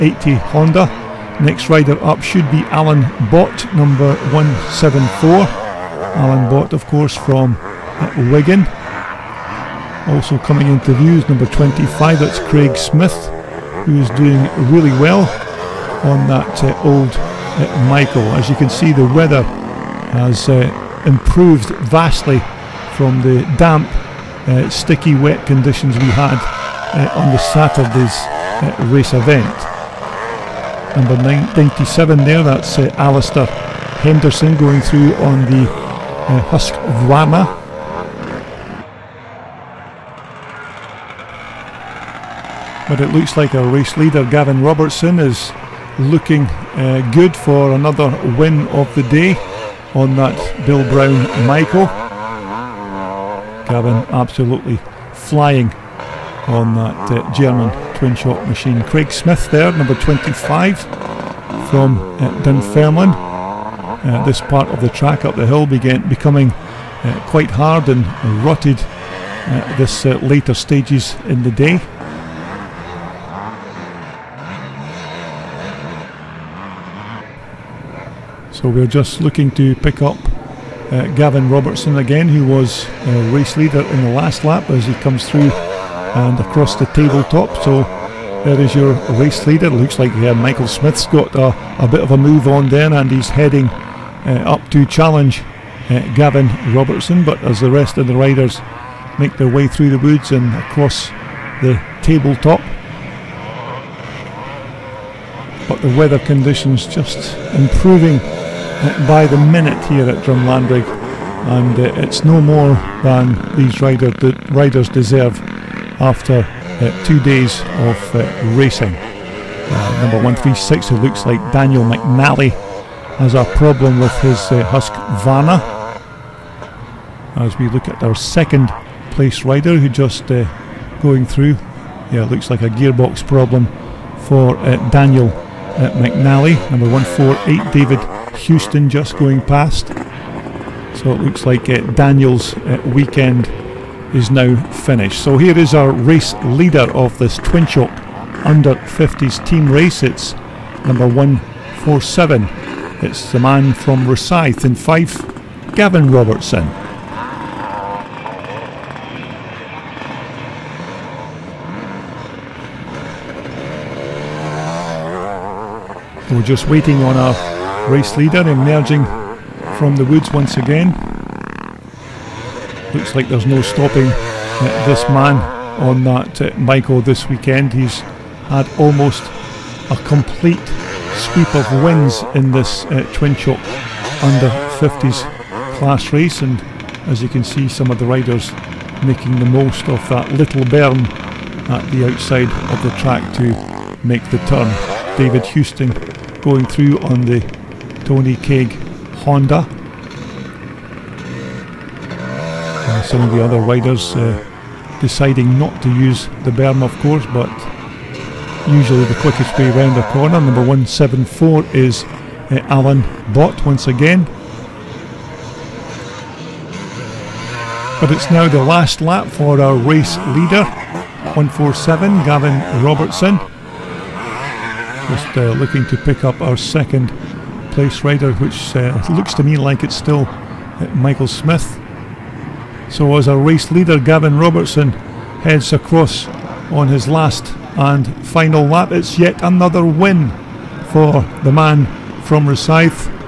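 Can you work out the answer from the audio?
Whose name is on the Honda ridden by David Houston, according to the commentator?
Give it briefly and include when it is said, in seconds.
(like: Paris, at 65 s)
Tony Keg, at 198 s.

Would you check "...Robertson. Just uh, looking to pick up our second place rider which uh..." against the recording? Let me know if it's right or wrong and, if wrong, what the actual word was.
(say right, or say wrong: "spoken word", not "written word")
right.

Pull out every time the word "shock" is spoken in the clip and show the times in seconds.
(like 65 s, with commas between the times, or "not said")
58 s, 147 s, 183 s.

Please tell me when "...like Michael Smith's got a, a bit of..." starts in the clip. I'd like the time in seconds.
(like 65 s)
89 s.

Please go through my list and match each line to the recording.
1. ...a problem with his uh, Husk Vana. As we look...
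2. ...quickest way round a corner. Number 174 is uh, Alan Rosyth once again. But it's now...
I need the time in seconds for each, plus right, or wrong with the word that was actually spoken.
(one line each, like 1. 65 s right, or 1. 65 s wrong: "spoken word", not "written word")
1. 123 s right
2. 209 s wrong: "Bott", not "Rosyth".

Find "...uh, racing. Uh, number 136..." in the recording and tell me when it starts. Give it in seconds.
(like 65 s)
118 s.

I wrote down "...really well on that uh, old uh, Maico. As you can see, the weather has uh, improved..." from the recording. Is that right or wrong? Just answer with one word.
right.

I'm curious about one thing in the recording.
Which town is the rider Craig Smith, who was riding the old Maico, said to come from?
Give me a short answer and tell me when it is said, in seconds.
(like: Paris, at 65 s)
Dunfermline, at 62 s.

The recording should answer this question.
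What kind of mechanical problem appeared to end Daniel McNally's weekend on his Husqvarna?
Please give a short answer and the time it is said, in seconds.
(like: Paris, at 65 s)
Gearbox problem, at 132 s.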